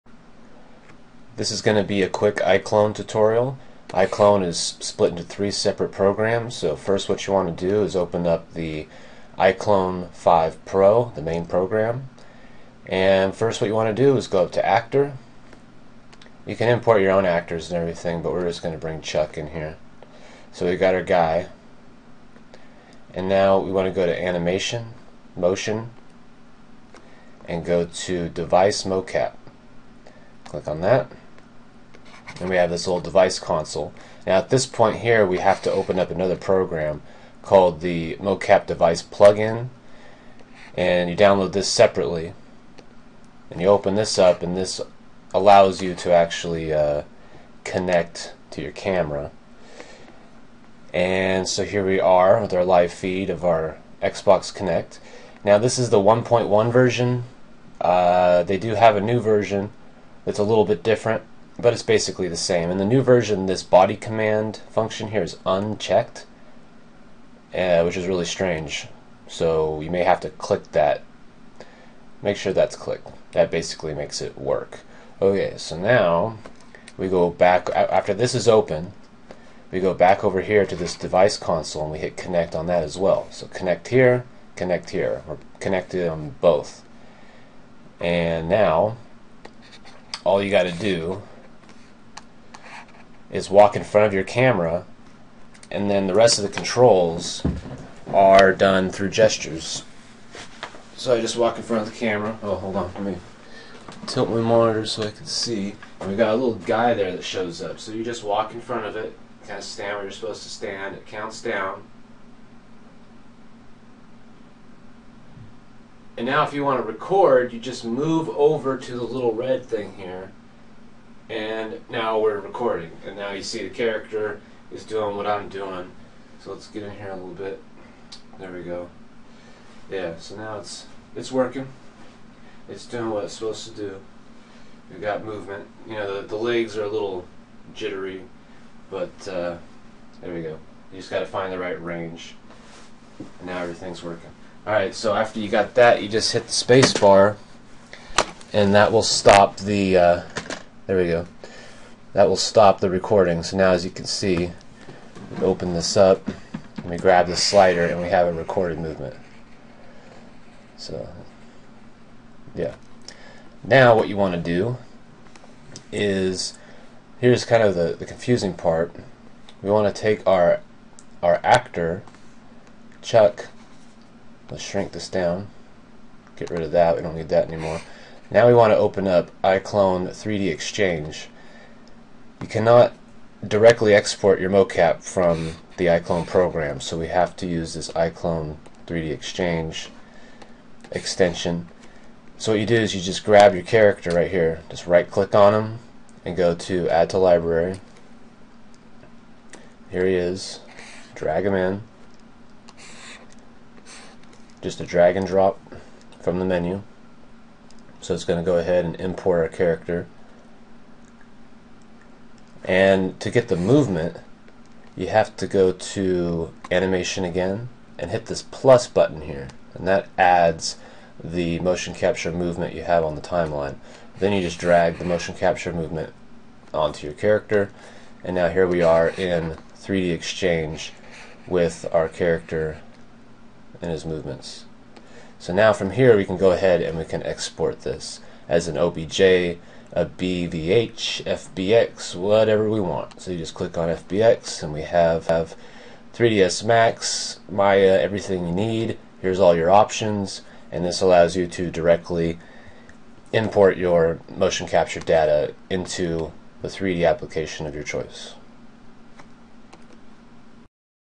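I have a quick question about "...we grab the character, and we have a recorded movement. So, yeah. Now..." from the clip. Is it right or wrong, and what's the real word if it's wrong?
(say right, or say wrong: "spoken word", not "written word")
wrong: "slider", not "character".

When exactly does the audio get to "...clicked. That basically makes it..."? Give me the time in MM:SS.
01:12.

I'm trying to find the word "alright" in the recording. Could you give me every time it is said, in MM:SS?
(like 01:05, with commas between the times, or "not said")
02:24.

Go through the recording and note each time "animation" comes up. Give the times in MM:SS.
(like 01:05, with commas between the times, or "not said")
00:24, 03:36.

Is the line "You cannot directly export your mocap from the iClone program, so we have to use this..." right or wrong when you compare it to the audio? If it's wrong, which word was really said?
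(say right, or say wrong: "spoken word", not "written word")
right.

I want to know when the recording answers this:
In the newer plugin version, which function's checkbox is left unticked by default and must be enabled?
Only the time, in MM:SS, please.
01:03.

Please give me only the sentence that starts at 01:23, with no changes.
So connect here, connect here, or connect them both.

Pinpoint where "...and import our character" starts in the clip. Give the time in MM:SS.
03:28.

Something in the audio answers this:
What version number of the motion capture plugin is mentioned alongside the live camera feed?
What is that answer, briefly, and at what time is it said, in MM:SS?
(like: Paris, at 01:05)
1.1, at 00:55.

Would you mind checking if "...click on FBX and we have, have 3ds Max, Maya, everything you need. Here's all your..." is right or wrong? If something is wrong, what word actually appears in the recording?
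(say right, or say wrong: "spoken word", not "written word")
right.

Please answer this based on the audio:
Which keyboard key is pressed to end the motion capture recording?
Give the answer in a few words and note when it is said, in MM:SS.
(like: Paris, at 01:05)
space bar, at 02:26.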